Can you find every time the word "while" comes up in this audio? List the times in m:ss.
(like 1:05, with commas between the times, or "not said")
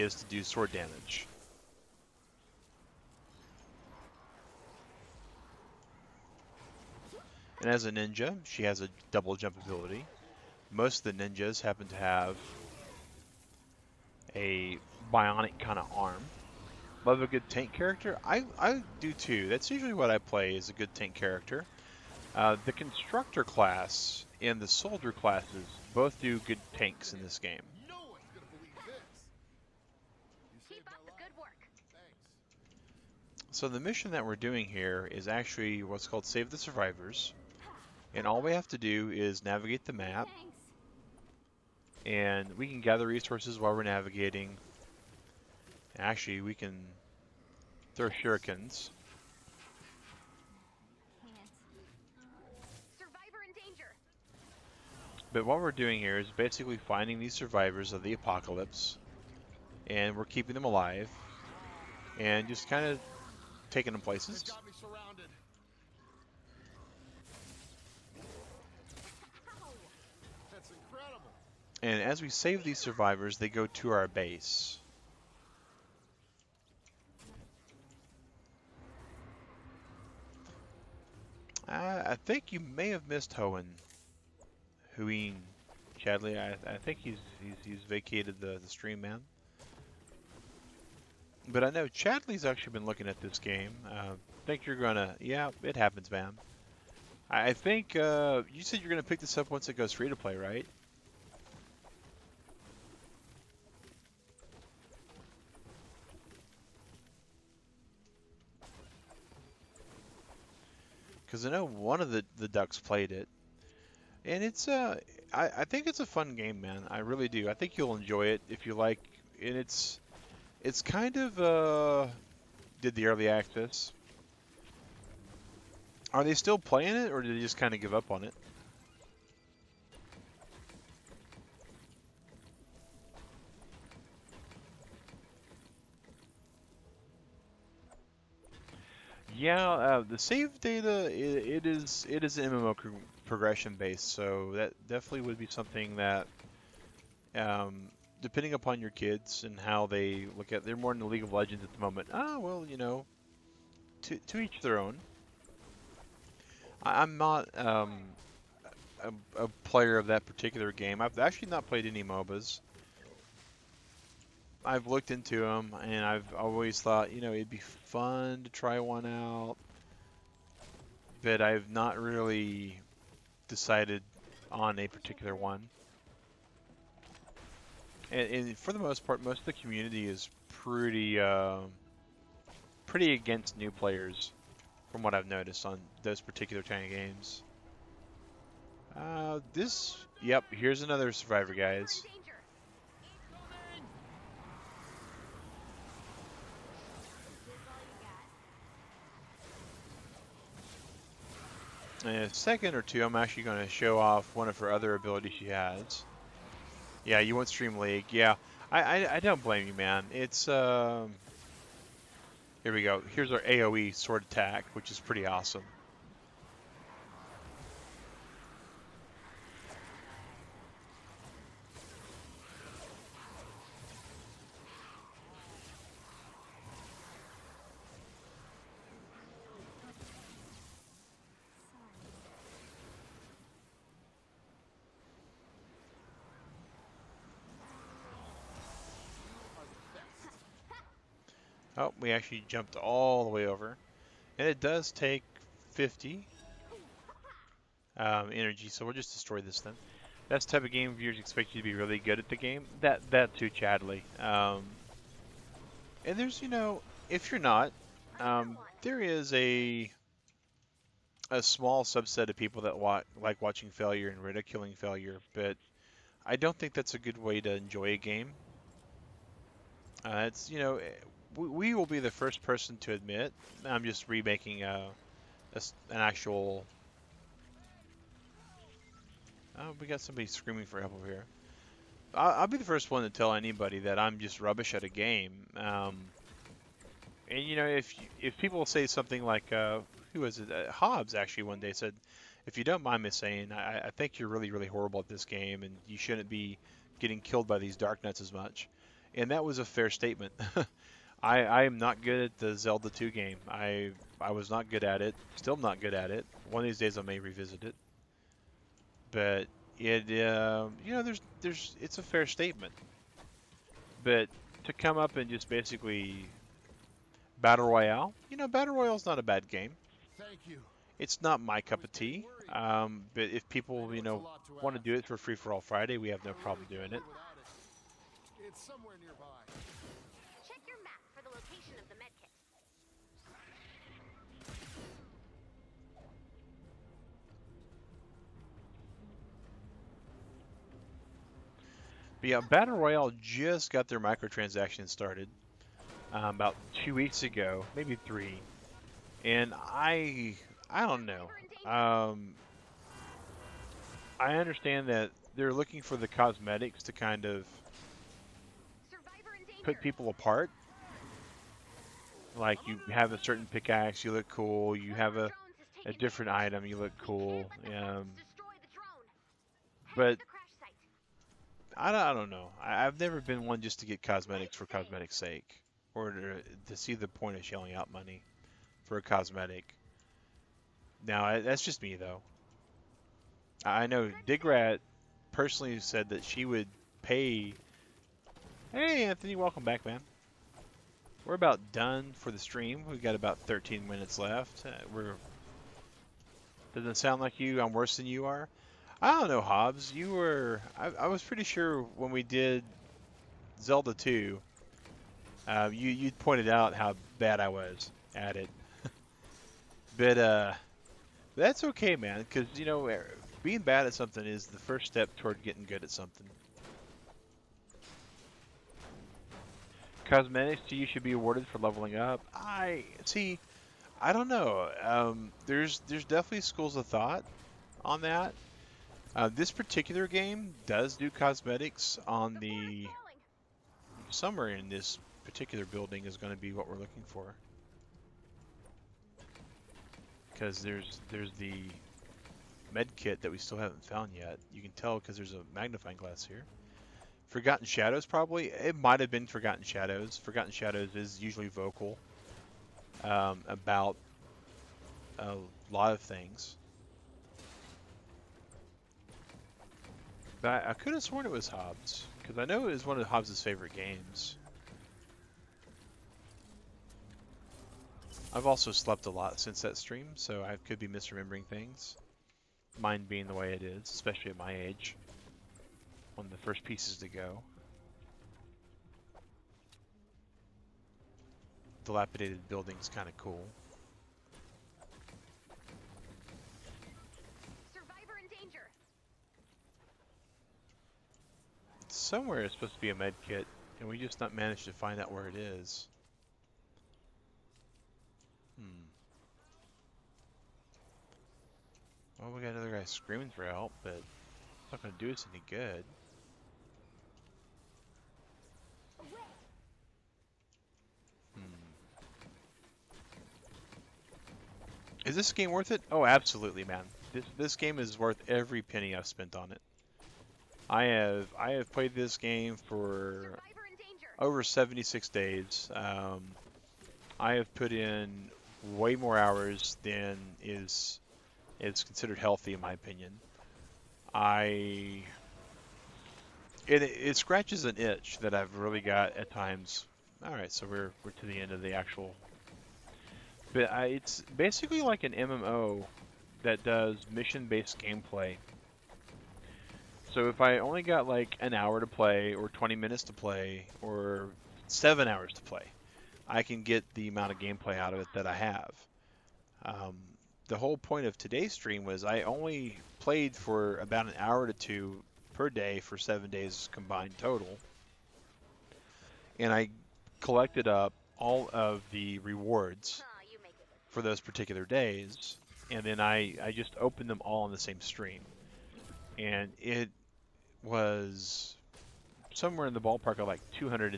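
0:43.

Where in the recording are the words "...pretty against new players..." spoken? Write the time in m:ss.
3:02.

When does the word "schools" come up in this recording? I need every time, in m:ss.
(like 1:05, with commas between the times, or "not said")
7:06.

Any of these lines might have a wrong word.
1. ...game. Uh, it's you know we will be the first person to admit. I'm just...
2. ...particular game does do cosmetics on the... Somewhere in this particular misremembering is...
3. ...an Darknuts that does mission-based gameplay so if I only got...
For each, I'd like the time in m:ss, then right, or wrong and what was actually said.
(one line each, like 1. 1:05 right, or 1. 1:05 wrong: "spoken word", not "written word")
1. 4:27 right
2. 7:09 wrong: "building", not "misremembering"
3. 9:05 wrong: "MMO", not "Darknuts".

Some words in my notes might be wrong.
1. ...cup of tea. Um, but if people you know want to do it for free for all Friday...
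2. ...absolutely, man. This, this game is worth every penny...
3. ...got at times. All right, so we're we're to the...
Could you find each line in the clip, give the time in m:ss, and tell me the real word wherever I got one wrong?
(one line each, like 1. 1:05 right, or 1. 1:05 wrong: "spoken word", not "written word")
1. 5:21 right
2. 8:36 right
3. 8:58 right.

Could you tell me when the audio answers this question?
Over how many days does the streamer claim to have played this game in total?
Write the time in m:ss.
8:44.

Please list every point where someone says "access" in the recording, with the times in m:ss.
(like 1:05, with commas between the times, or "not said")
2:03.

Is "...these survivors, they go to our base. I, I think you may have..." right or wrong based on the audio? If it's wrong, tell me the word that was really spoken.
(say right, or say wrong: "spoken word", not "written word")
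right.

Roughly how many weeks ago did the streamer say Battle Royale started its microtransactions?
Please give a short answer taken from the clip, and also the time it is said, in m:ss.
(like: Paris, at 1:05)
2, at 5:46.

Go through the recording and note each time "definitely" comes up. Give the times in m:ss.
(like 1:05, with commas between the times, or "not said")
2:24, 7:06.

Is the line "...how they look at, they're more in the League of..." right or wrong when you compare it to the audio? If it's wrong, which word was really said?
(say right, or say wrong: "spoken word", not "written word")
right.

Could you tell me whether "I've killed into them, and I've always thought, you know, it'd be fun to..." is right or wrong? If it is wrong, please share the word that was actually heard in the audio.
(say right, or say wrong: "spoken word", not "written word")
wrong: "looked", not "killed".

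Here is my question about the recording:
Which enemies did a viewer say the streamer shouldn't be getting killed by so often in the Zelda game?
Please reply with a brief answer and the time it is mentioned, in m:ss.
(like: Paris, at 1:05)
Darknuts, at 4:57.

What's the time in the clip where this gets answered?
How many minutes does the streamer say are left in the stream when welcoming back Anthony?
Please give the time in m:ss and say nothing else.
6:33.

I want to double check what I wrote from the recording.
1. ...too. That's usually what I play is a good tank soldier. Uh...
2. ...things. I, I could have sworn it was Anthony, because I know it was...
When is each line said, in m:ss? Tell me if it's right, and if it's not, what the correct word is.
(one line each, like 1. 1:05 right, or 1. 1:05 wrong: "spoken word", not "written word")
1. 0:19 wrong: "character", not "soldier"
2. 7:36 wrong: "Hobbs", not "Anthony".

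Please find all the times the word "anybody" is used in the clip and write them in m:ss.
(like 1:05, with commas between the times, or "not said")
4:43.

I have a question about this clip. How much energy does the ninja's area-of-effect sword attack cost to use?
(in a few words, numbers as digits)
50.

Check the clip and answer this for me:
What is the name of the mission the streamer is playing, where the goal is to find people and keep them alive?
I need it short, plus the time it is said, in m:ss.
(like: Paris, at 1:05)
Save the Survivors, at 0:36.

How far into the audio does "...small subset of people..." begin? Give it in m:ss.
4:21.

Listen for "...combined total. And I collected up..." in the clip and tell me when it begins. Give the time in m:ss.
9:26.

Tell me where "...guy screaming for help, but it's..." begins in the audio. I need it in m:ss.
8:22.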